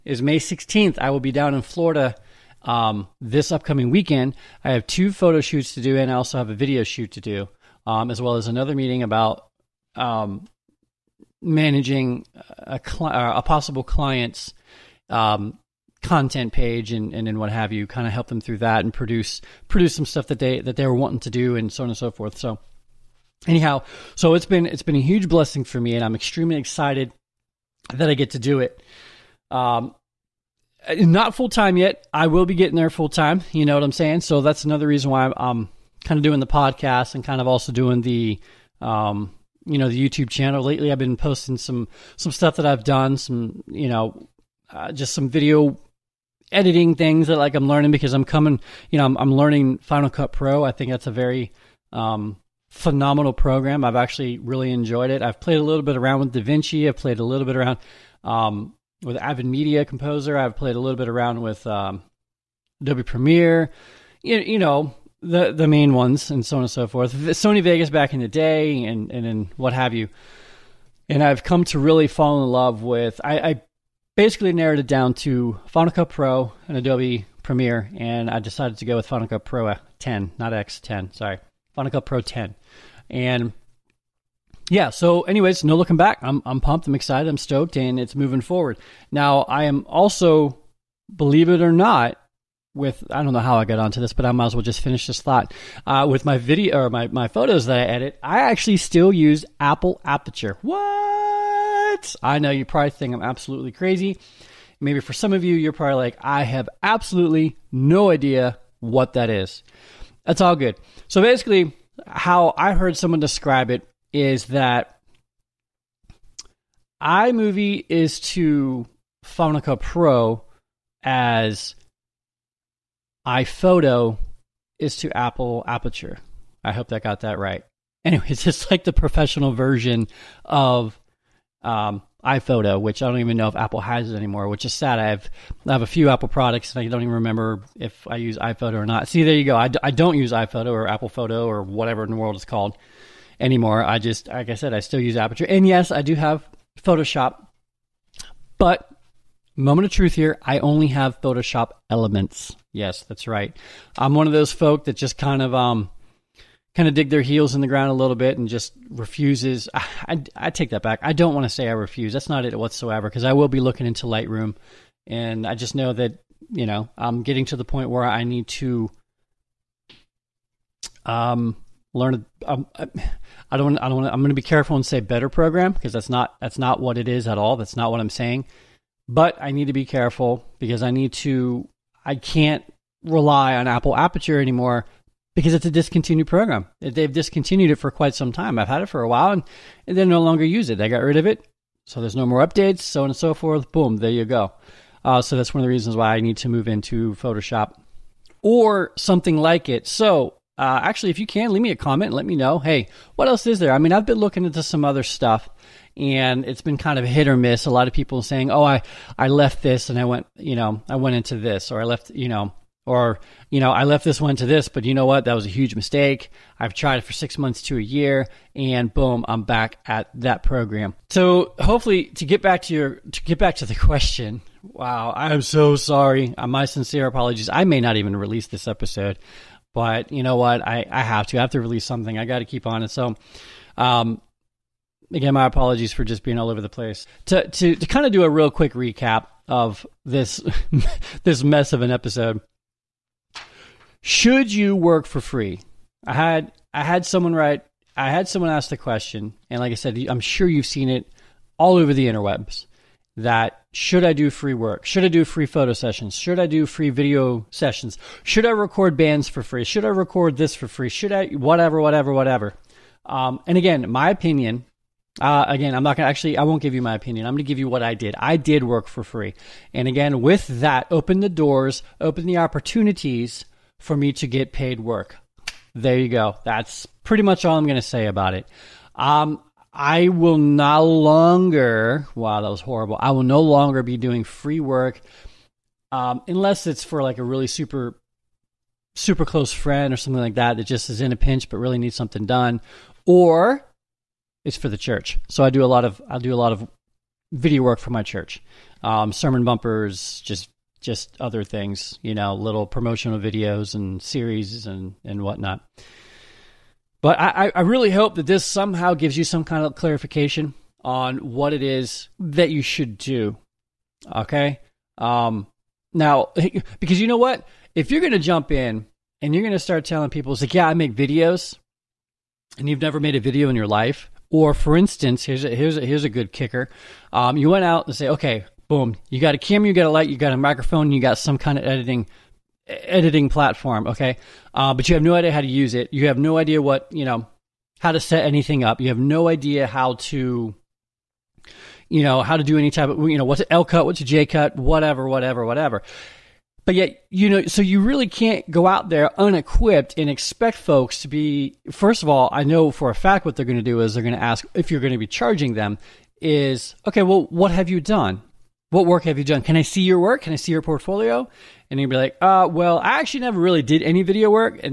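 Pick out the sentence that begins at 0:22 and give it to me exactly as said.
So anyhow, so it's been it's been a huge blessing for me and I'm extremely excited that I get to do it.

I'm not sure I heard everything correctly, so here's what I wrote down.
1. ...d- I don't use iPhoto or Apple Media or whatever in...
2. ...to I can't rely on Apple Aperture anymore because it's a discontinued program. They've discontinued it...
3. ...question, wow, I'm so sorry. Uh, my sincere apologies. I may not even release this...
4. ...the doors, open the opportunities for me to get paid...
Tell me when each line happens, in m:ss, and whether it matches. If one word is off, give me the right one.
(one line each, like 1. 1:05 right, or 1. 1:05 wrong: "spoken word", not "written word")
1. 2:19 wrong: "Photo", not "Media"
2. 3:01 right
3. 3:43 right
4. 4:31 right.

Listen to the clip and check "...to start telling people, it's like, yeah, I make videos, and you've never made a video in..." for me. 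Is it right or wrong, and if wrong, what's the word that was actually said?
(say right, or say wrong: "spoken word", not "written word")
right.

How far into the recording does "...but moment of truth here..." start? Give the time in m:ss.
2:28.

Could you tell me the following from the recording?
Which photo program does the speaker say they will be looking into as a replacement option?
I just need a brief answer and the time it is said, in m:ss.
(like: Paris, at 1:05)
Lightroom, at 2:44.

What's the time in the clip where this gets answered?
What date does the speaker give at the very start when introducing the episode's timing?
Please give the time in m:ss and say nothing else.
0:00.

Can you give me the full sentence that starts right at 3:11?
So there's no more updates, so on and so forth.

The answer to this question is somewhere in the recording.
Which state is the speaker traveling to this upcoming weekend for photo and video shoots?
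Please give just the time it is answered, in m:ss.
0:01.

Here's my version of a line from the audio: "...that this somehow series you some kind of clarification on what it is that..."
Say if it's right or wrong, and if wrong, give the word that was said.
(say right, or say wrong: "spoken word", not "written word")
wrong: "gives", not "series".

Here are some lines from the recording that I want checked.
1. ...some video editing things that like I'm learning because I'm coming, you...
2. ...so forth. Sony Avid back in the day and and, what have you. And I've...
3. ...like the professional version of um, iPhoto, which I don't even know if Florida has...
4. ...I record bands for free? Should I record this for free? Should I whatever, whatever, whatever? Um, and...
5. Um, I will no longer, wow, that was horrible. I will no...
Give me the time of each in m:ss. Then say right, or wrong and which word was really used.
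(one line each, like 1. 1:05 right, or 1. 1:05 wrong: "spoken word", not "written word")
1. 0:45 right
2. 1:06 wrong: "Vegas", not "Avid"
3. 2:08 wrong: "Apple", not "Florida"
4. 4:18 right
5. 4:38 right.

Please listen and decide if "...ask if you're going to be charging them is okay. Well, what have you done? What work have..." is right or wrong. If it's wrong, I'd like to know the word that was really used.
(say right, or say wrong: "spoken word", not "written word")
right.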